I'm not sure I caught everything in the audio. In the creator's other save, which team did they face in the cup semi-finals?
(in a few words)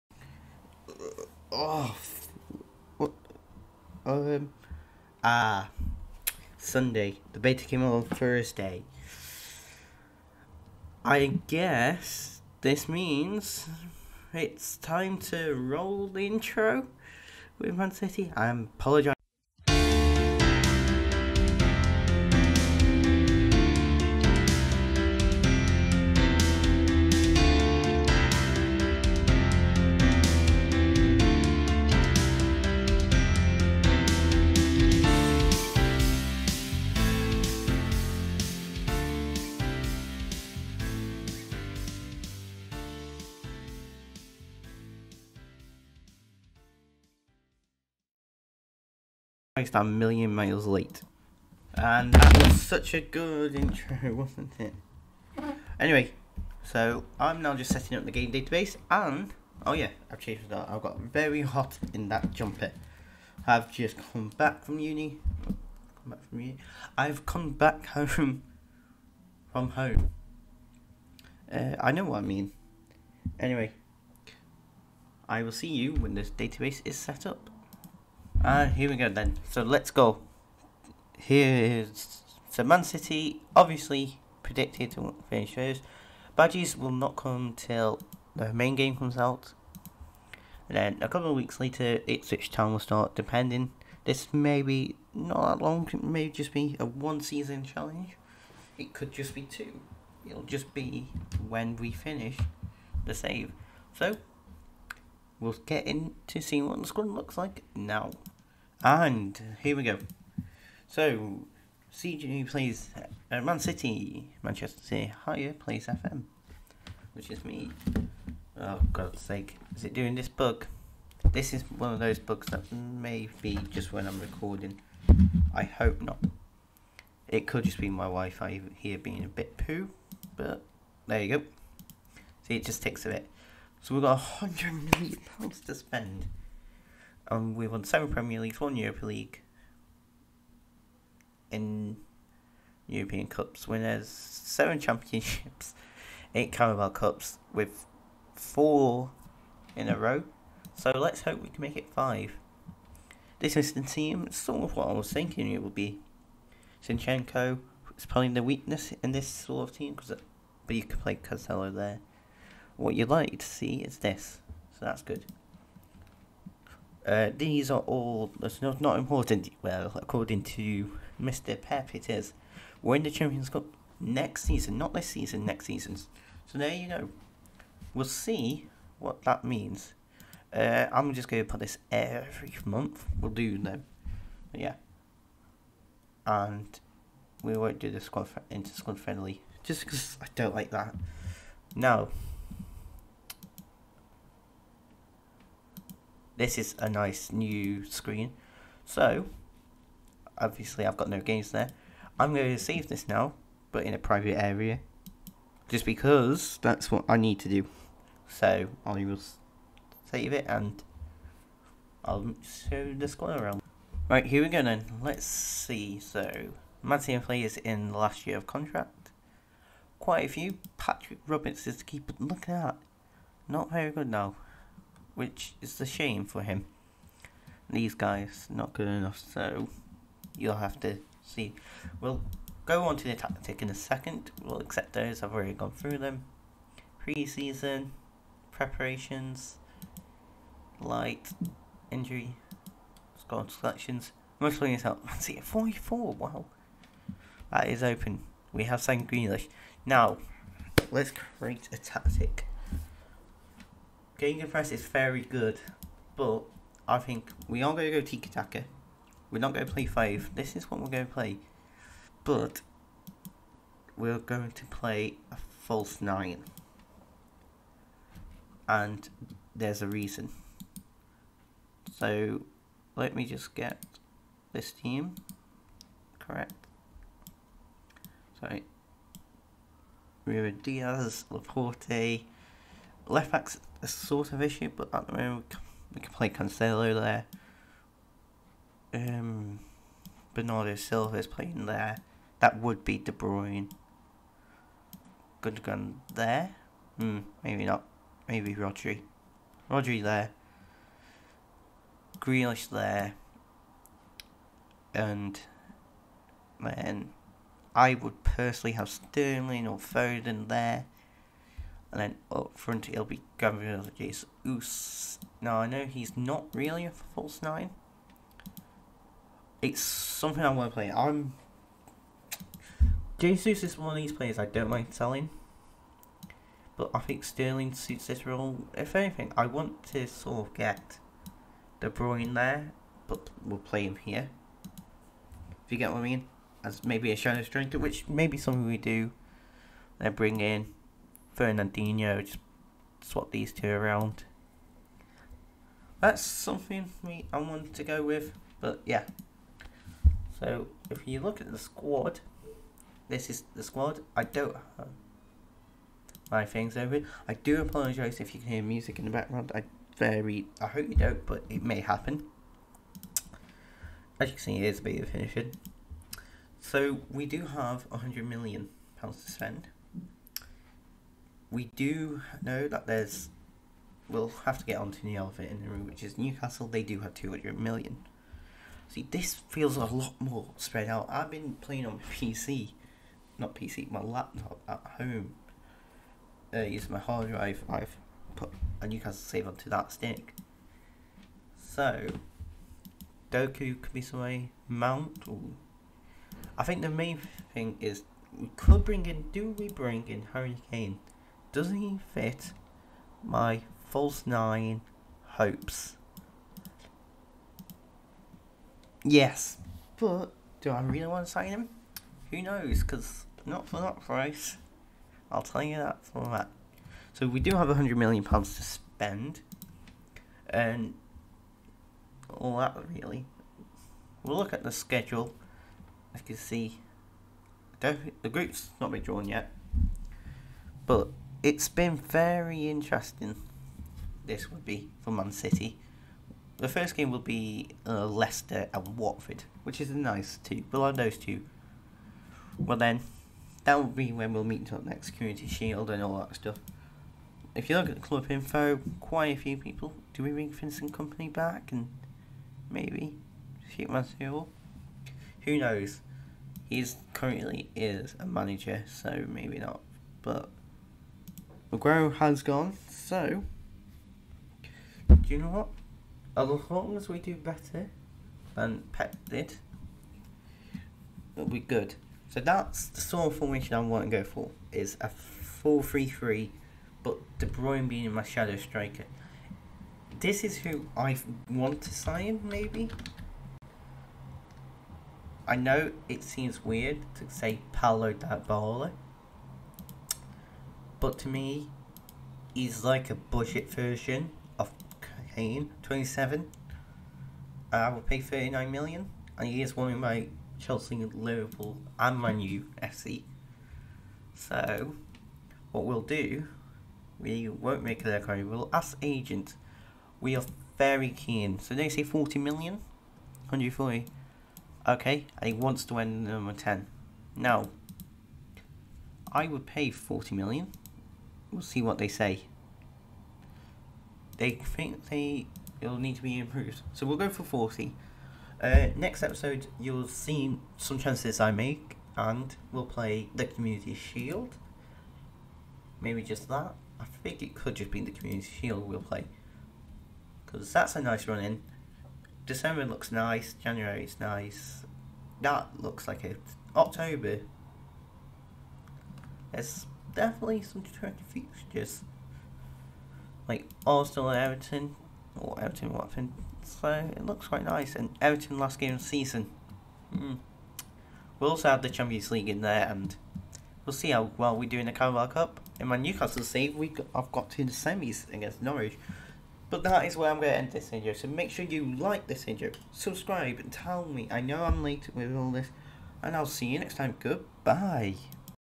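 Norwich.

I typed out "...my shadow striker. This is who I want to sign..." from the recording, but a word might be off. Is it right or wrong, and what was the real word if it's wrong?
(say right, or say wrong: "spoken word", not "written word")
right.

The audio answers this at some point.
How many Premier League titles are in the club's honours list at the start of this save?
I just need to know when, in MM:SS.
02:17.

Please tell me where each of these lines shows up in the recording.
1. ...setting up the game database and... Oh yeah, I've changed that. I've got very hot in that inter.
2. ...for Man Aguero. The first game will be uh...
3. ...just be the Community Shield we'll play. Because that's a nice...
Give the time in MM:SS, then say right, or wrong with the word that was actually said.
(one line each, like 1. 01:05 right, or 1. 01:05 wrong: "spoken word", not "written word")
1. 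00:57 wrong: "jumper", not "inter"
2. 07:15 wrong: "City", not "Aguero"
3. 08:57 right.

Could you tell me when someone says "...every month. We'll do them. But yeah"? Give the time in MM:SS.
03:01.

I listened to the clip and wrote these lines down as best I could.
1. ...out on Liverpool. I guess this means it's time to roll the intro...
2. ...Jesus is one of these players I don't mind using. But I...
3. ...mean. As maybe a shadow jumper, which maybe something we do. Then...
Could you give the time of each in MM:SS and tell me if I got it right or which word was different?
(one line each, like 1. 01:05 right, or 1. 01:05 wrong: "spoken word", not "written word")
1. 00:07 wrong: "Thursday", not "Liverpool"
2. 05:23 wrong: "selling", not "using"
3. 05:36 wrong: "striker", not "jumper".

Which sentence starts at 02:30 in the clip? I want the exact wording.
So let's hope we can make it five.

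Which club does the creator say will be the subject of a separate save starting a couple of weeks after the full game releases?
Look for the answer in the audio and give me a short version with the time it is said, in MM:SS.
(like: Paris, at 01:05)
Ipswich Town, at 01:32.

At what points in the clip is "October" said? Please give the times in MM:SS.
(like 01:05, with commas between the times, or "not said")
09:06.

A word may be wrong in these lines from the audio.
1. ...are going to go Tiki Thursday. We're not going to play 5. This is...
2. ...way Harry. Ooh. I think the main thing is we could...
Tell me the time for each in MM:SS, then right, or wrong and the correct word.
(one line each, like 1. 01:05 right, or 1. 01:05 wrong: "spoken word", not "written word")
1. 04:17 wrong: "Taka", not "Thursday"
2. 06:34 wrong: "Mount", not "Harry".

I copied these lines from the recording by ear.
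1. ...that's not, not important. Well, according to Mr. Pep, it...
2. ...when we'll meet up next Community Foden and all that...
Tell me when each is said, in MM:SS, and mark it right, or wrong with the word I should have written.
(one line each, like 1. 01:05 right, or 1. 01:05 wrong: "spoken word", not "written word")
1. 02:48 right
2. 07:24 wrong: "Shield", not "Foden".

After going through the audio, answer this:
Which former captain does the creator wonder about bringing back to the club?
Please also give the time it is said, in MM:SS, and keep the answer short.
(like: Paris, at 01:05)
Vincent Kompany, at 07:30.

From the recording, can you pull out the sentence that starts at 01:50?
So, CJ plays uh, Man City, Manchester City higher plays FM, which is me.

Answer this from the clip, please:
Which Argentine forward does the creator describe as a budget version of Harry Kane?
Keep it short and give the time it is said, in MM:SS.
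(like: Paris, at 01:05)
Paulo Dybala, at 08:07.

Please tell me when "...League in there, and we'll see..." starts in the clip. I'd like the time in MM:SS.
09:22.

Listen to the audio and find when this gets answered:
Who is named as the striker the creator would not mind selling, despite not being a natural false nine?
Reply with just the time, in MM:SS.
05:13.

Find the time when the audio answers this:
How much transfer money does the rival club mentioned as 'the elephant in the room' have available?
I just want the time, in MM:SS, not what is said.
06:17.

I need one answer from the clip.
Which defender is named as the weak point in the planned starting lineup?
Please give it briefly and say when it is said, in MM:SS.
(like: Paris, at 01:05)
Zinchenko, at 02:36.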